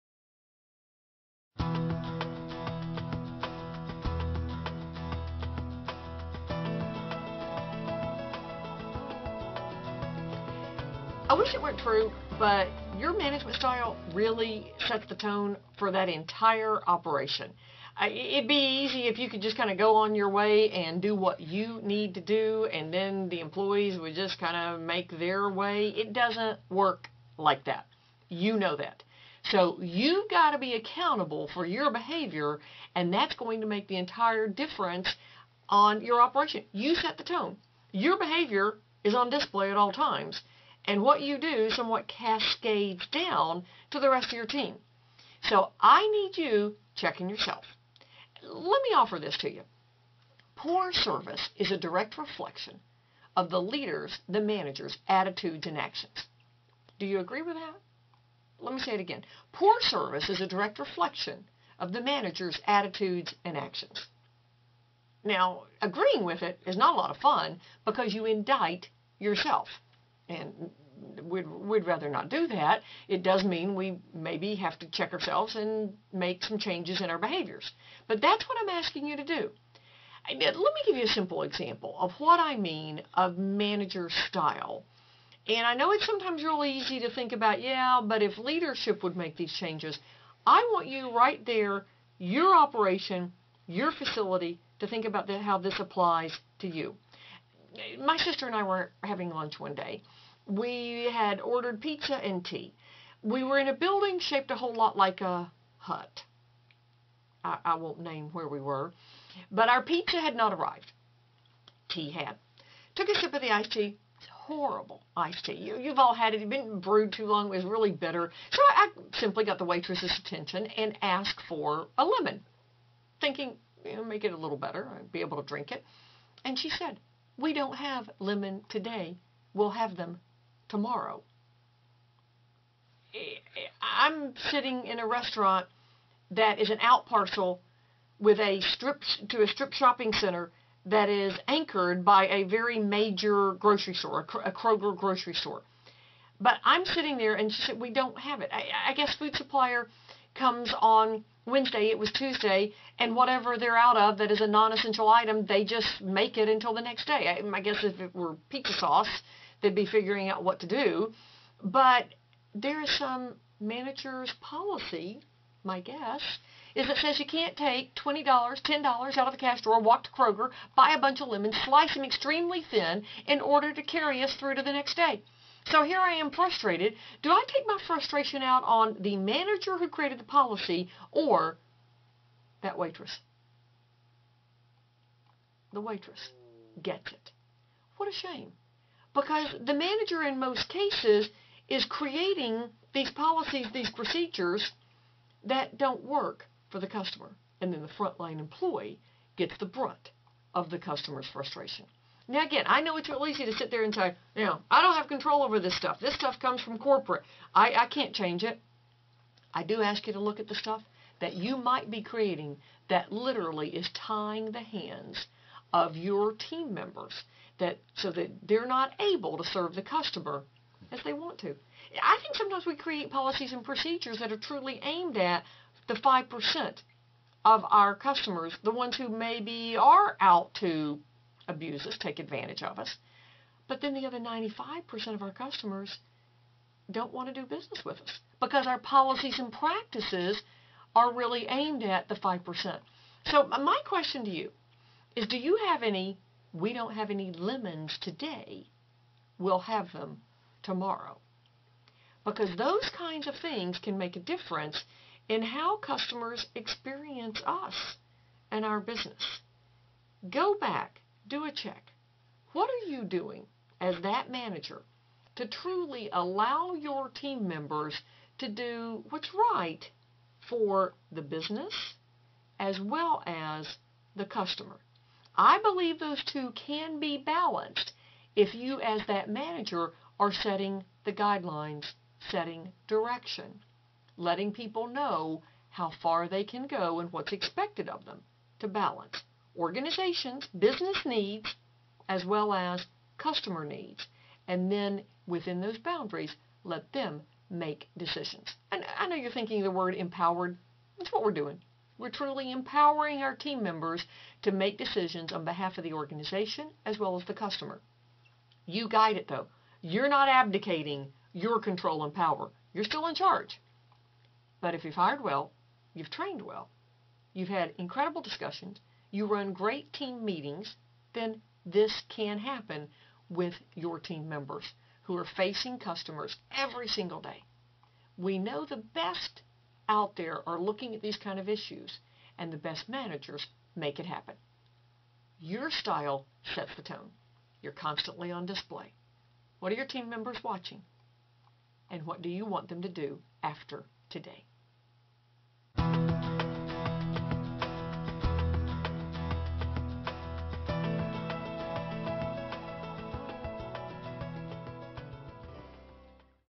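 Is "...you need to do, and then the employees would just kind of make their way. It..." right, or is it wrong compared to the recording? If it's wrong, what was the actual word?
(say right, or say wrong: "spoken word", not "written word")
right.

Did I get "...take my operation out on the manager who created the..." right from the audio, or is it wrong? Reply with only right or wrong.
wrong.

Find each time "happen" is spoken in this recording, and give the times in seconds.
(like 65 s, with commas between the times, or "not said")
322 s, 334 s.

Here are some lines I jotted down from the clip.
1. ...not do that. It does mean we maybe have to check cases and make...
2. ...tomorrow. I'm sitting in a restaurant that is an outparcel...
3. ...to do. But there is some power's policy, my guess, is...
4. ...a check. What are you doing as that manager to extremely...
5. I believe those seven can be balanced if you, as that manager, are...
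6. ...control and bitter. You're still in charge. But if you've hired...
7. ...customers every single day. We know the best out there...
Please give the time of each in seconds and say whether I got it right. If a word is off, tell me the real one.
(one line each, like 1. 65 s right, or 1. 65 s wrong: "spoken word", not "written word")
1. 72 s wrong: "ourselves", not "cases"
2. 130 s right
3. 160 s wrong: "manager", not "power"
4. 261 s wrong: "truly", not "extremely"
5. 275 s wrong: "two", not "seven"
6. 311 s wrong: "power", not "bitter"
7. 325 s right.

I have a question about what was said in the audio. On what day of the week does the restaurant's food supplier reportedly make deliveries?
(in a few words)
Wednesday.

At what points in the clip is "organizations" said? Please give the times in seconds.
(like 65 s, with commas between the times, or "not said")
289 s, 305 s.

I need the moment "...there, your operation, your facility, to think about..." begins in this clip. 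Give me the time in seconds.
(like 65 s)
91 s.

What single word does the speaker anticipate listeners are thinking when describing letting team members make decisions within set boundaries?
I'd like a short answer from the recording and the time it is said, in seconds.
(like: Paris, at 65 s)
empowered, at 299 s.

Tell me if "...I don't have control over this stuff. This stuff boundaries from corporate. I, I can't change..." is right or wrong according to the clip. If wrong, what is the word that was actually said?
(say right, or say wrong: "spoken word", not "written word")
wrong: "comes", not "boundaries".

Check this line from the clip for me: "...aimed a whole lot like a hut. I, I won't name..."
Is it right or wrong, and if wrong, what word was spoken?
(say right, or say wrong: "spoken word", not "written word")
wrong: "shaped", not "aimed".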